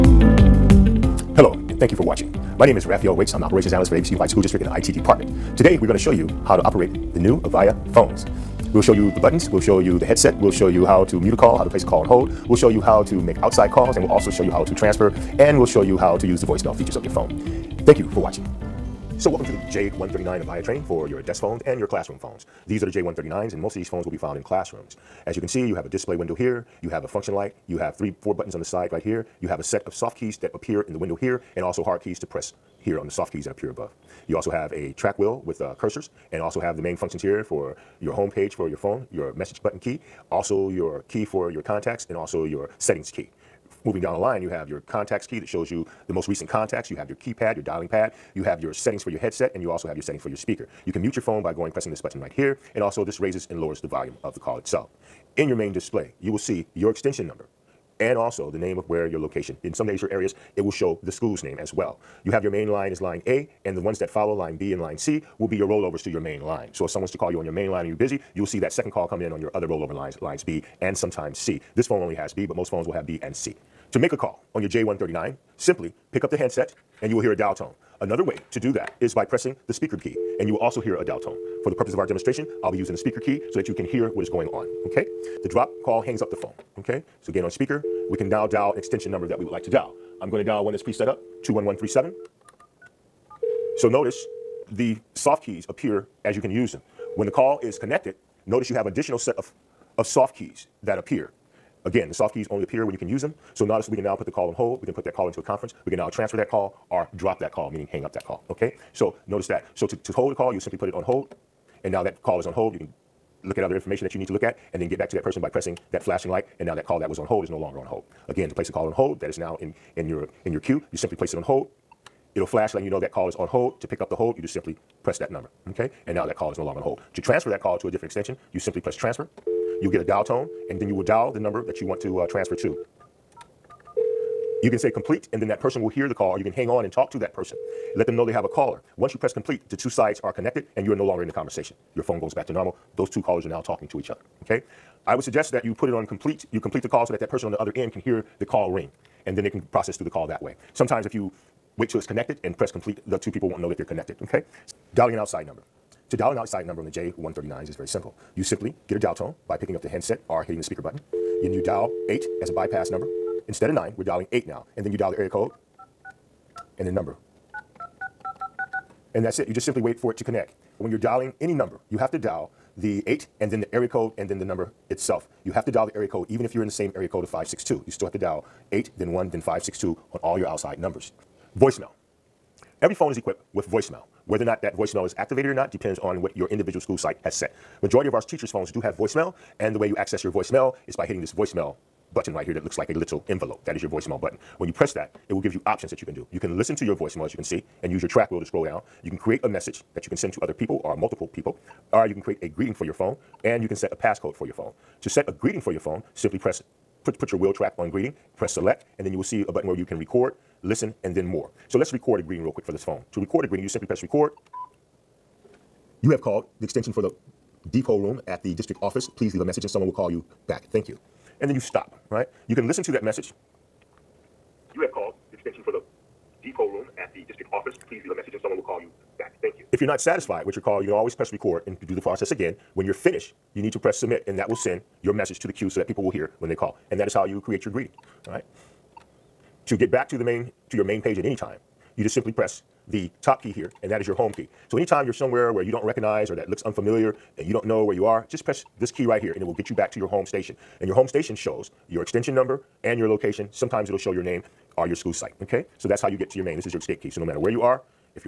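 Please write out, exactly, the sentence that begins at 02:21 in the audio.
Your phone goes back to normal.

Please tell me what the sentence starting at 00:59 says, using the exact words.
In some or areas, it will show the school's name as well.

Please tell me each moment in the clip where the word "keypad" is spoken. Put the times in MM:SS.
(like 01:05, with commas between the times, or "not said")
00:47.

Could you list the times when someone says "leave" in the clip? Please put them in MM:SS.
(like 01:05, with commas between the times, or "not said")
03:39, 03:48.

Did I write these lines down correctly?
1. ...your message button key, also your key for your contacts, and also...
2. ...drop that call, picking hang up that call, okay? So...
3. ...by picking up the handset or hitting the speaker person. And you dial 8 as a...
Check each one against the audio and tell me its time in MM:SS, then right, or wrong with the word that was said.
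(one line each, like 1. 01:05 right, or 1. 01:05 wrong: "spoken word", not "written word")
1. 00:39 right
2. 01:47 wrong: "meaning", not "picking"
3. 02:39 wrong: "button", not "person".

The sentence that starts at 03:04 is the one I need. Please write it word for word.
Whether or not that voicemail is activated or not depends on what your individual school site has set.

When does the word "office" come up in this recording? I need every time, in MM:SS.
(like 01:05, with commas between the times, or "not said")
03:38, 03:47.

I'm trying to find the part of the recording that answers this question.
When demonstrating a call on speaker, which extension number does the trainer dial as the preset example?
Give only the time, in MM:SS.
01:31.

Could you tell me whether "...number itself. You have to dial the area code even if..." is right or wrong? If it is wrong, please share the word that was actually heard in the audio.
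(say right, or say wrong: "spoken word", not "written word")
right.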